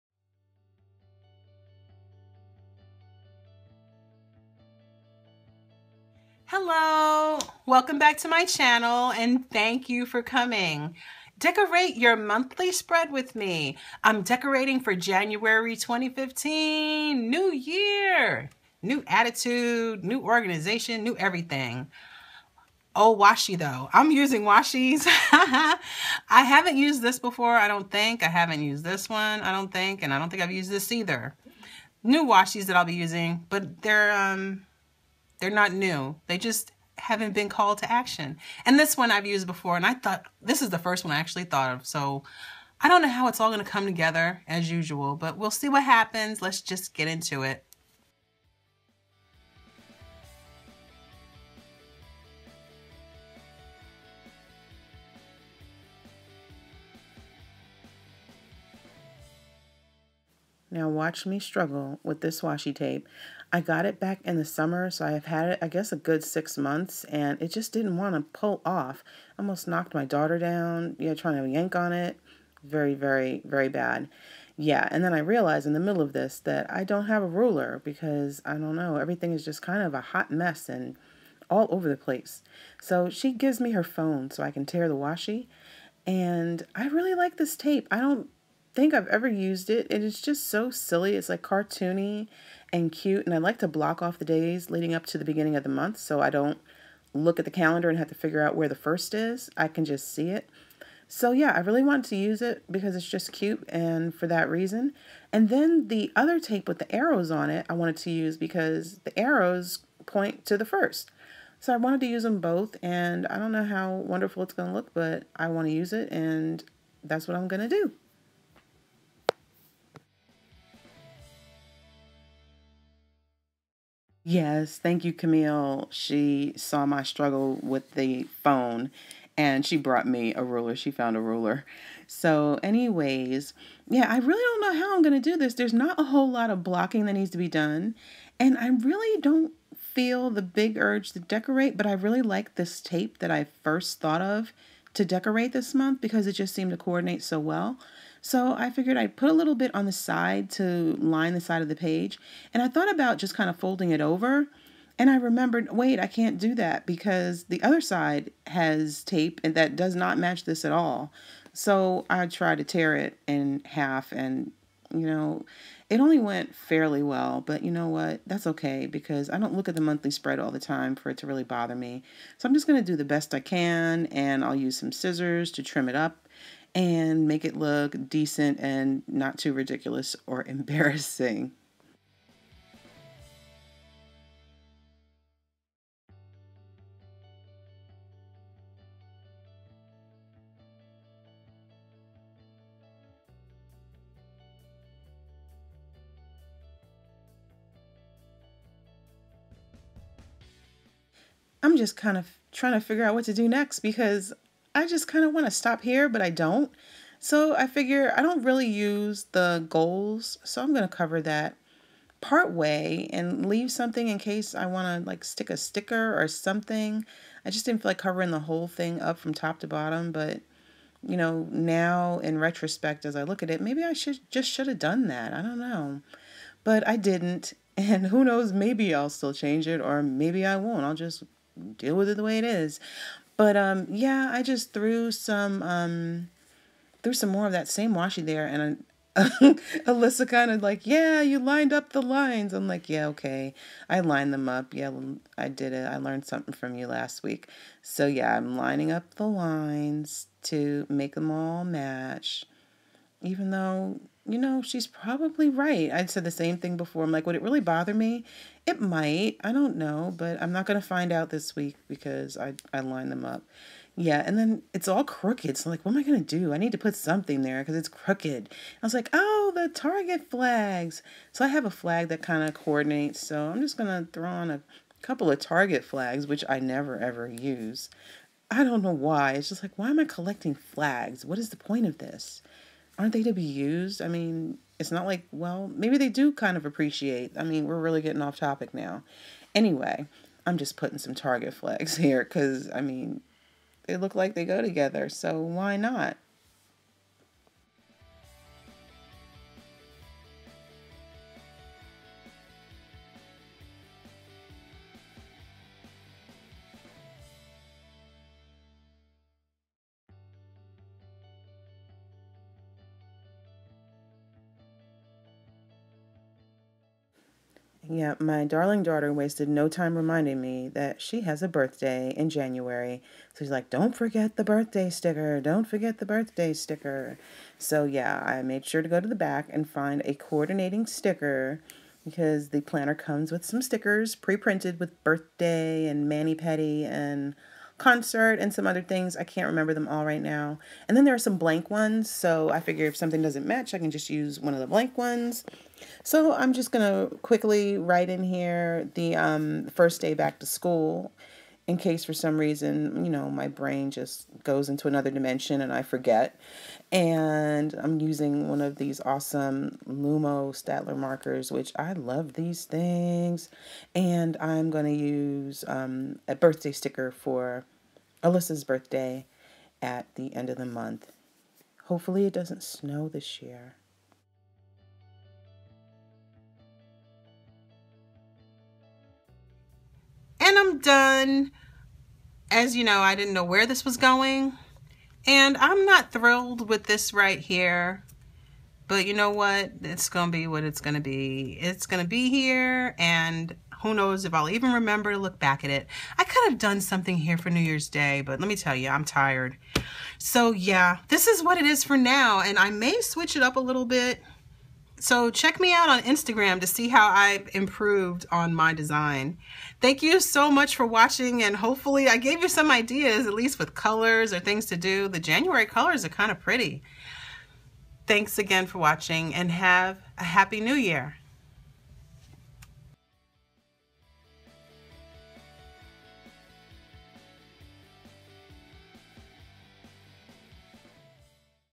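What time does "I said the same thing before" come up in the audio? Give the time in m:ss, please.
4:15.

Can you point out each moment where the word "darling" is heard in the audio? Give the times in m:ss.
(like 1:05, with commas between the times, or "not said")
5:18.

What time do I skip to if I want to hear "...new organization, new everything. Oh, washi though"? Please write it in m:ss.
0:20.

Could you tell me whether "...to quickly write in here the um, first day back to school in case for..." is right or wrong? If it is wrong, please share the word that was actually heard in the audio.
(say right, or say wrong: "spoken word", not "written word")
right.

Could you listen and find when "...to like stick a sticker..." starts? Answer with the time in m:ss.
3:35.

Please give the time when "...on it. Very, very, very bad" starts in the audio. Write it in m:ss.
1:11.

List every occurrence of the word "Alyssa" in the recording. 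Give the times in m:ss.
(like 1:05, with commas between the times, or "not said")
3:59, 6:08.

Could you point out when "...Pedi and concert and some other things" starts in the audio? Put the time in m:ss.
5:36.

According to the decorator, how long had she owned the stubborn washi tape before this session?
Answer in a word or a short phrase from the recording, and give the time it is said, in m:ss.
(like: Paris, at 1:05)
6 months, at 1:06.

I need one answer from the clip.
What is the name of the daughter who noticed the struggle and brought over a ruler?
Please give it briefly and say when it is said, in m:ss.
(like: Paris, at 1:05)
Camille, at 2:05.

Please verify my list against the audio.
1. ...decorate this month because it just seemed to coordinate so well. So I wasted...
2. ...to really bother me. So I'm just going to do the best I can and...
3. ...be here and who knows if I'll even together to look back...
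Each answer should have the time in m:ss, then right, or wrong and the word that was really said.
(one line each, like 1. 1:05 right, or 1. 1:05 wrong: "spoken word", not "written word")
1. 2:25 wrong: "figured", not "wasted"
2. 2:51 right
3. 6:32 wrong: "remember", not "together".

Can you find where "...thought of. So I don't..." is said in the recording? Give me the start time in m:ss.
0:41.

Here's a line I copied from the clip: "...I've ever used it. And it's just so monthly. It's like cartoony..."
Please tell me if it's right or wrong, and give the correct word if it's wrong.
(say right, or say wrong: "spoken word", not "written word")
wrong: "silly", not "monthly".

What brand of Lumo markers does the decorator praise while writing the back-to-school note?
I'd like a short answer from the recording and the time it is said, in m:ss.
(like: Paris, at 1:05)
Staedtler, at 6:00.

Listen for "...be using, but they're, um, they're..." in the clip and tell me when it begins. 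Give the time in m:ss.
0:32.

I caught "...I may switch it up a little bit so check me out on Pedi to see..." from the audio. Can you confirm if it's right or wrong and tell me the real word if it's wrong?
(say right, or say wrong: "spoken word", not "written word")
wrong: "Instagram", not "Pedi".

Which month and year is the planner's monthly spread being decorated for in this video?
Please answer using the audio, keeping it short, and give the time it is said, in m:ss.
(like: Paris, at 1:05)
January 2015, at 0:14.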